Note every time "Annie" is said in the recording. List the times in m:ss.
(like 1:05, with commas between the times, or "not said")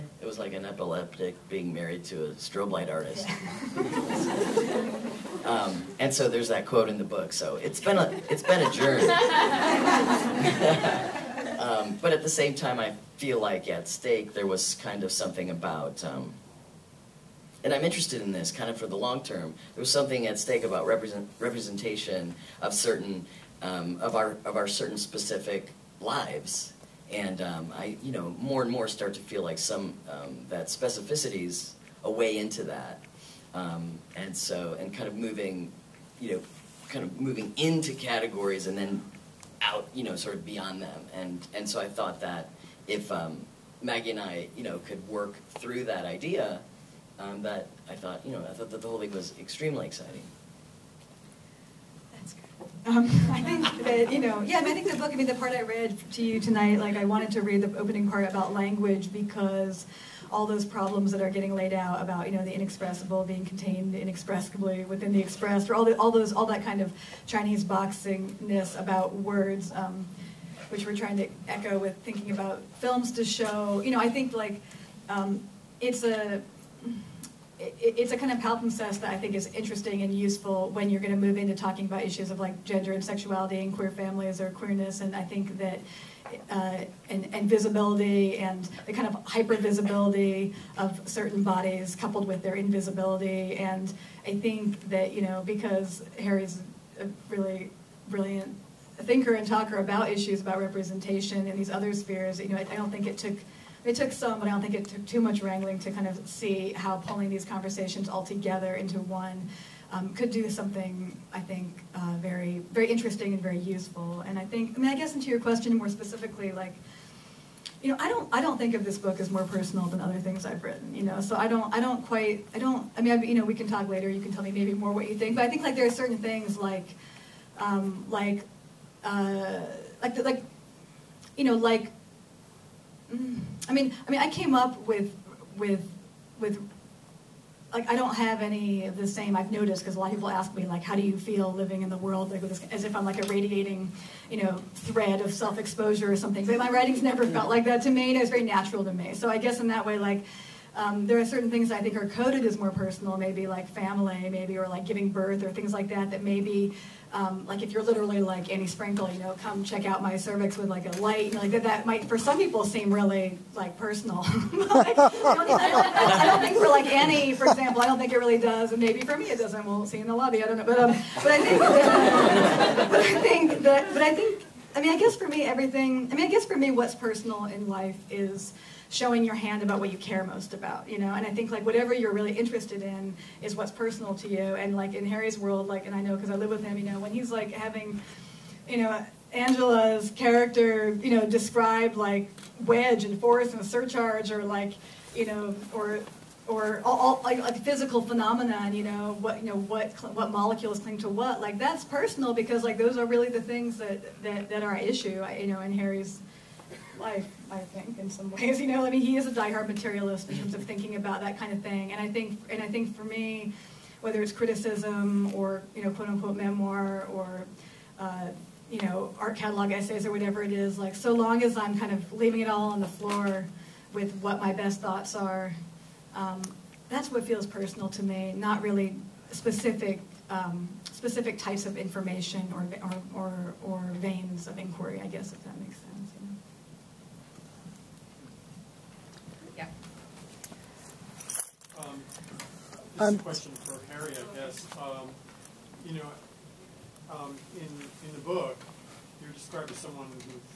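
2:38, 2:46.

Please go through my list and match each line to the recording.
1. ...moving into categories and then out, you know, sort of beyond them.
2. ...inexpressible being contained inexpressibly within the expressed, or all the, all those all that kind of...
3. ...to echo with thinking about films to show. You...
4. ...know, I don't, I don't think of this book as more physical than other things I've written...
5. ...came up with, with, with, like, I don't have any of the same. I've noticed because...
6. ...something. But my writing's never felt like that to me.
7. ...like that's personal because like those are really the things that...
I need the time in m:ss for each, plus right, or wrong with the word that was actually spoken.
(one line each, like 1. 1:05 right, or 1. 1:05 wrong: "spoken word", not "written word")
1. 0:37 right
2. 1:02 right
3. 1:11 right
4. 1:57 wrong: "personal", not "physical"
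5. 2:14 right
6. 2:26 right
7. 3:21 right.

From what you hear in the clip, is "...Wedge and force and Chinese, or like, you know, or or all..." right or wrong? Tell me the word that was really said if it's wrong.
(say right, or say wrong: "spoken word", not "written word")
wrong: "Surcharge", not "Chinese".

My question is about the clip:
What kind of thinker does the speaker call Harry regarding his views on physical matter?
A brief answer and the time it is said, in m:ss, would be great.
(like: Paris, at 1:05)
diehard materialist, at 3:29.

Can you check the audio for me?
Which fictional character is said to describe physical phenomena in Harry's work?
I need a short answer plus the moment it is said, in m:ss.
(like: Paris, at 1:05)
Angela, at 3:09.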